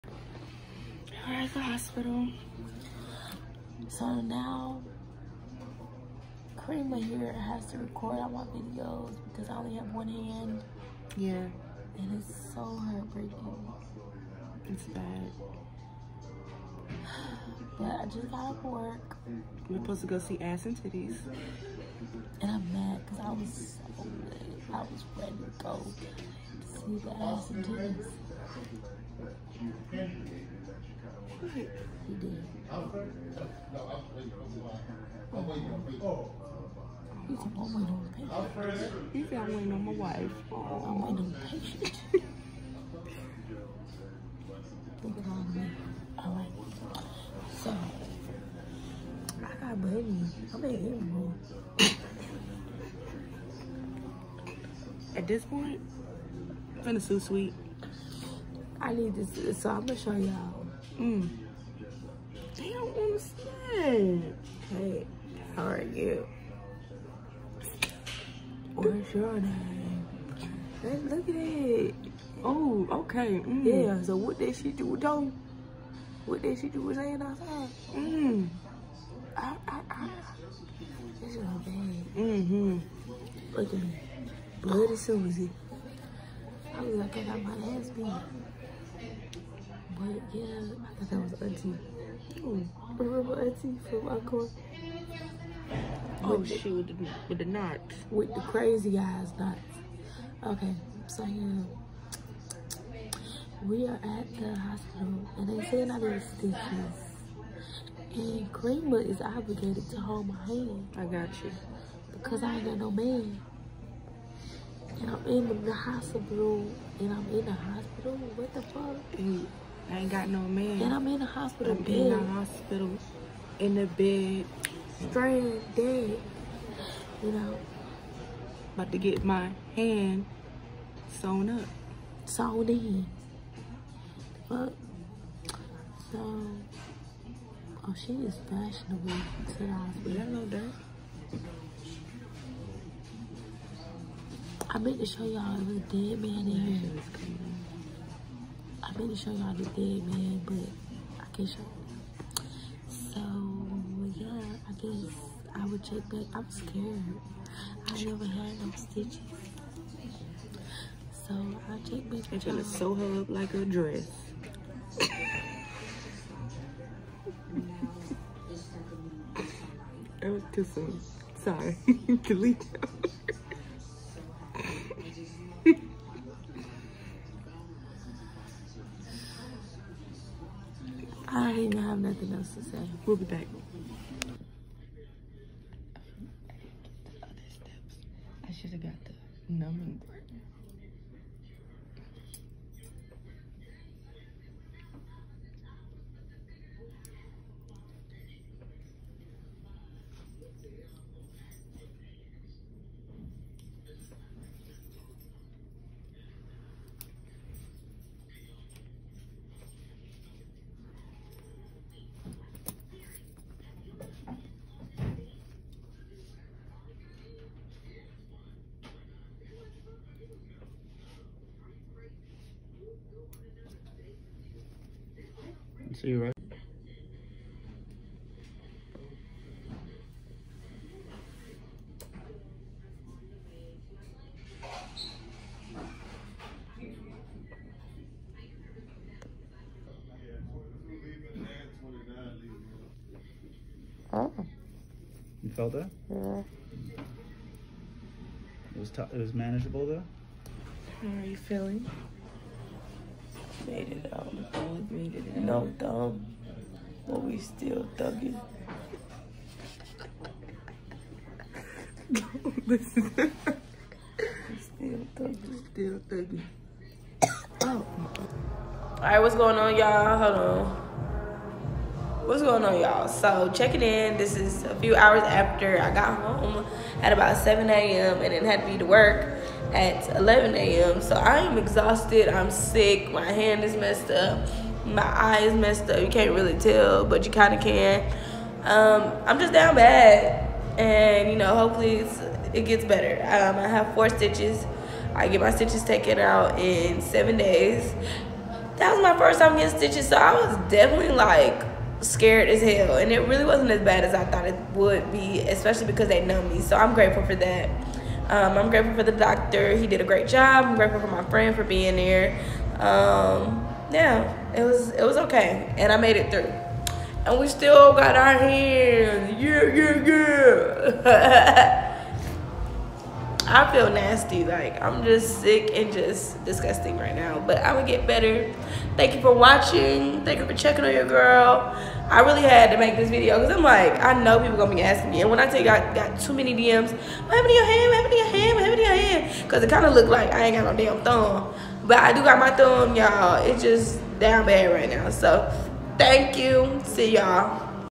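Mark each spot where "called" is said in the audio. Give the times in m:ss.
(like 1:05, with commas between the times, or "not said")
0:45.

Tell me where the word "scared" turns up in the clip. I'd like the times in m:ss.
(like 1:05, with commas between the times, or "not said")
2:36, 5:01.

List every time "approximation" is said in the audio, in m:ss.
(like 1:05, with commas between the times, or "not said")
not said.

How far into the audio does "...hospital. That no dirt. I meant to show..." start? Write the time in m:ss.
2:19.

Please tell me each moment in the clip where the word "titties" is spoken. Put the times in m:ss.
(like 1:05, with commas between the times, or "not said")
0:20, 0:27.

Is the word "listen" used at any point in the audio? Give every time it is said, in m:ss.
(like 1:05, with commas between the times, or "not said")
4:22.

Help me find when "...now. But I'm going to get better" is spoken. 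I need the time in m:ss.
5:27.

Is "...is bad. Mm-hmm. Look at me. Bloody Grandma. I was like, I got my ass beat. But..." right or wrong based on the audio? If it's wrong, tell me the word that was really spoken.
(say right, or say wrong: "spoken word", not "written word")
wrong: "Susie", not "Grandma".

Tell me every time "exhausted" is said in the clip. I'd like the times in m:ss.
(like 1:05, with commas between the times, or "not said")
4:41.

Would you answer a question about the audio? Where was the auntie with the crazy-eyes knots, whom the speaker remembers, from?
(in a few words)
Encore.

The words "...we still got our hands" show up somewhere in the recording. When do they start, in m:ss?
5:17.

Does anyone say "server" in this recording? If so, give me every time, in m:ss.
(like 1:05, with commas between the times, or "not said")
not said.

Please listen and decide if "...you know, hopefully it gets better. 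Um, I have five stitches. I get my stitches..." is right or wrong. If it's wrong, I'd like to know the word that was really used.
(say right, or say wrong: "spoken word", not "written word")
wrong: "four", not "five".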